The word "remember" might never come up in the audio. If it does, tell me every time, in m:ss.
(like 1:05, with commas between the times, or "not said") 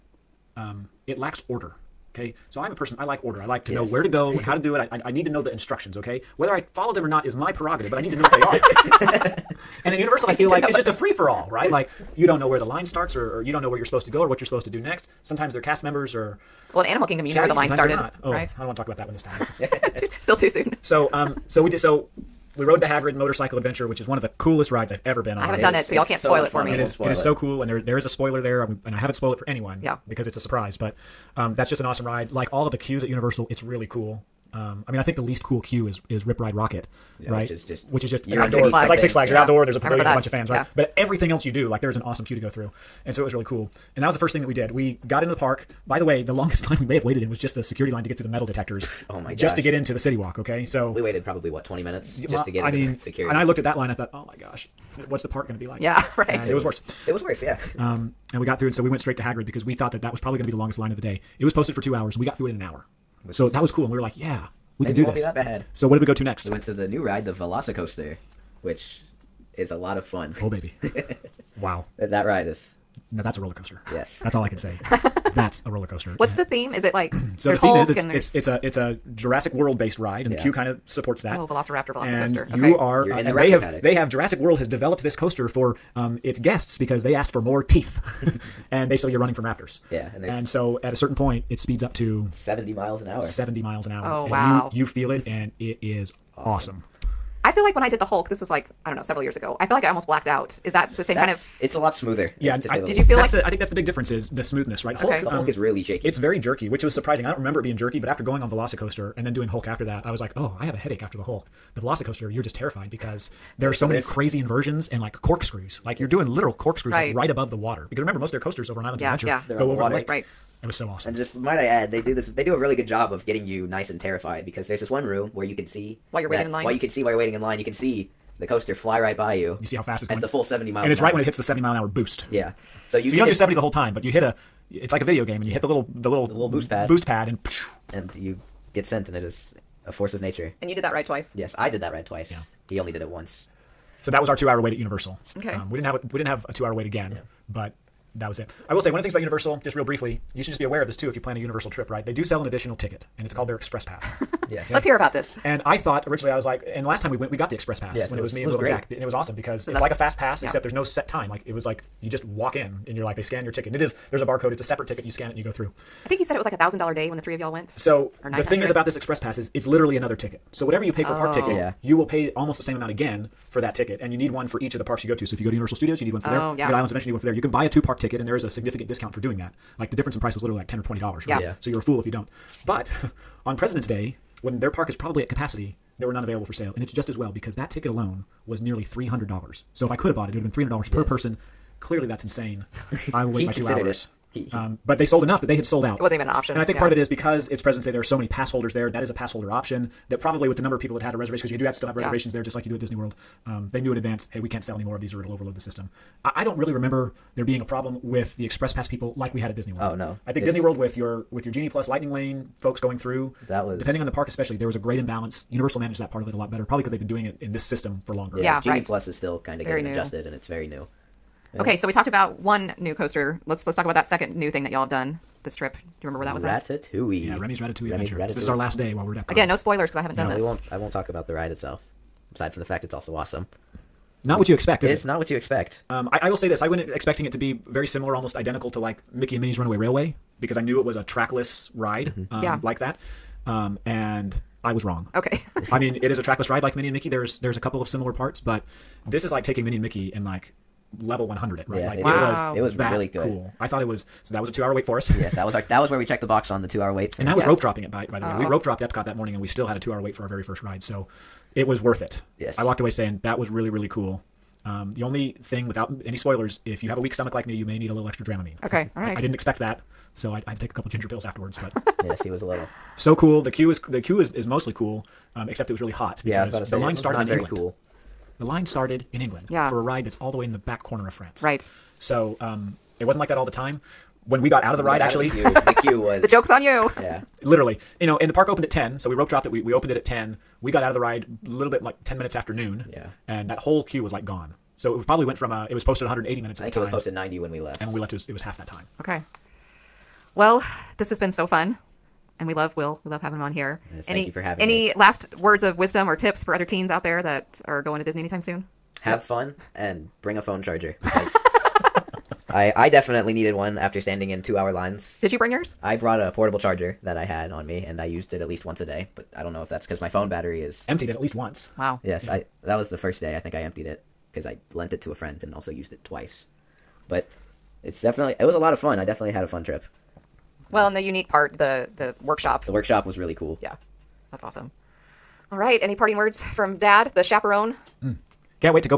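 1:47, 1:58, 3:26, 3:46.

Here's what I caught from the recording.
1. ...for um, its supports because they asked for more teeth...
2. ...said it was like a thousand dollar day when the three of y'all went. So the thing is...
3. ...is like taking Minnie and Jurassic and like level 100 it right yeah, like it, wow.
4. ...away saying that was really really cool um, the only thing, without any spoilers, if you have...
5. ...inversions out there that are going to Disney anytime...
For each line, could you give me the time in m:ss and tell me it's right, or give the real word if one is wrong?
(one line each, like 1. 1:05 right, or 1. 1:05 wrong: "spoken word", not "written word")
1. 1:25 wrong: "guests", not "supports"
2. 2:46 right
3. 4:09 wrong: "Mickey", not "Jurassic"
4. 4:22 right
5. 5:06 wrong: "teens", not "inversions".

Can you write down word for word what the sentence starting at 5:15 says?
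I brought a portable charger that I had on me, and I used it at least once a day.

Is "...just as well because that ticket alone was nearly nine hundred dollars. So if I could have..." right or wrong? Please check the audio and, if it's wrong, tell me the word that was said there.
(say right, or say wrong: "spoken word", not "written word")
wrong: "three", not "nine".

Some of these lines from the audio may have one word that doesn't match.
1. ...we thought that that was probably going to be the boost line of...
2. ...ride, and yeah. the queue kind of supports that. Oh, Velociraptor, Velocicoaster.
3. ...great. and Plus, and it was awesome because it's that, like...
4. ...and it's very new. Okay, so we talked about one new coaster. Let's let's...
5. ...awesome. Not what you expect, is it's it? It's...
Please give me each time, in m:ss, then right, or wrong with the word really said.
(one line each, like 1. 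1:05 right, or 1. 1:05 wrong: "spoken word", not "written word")
1. 0:59 wrong: "longest", not "boost"
2. 1:19 right
3. 2:38 wrong: "Jack", not "Plus"
4. 3:40 right
5. 3:53 right.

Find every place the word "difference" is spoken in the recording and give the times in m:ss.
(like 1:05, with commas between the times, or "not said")
1:43, 2:59.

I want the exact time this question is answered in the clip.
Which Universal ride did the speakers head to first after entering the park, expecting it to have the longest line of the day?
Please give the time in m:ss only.
0:22.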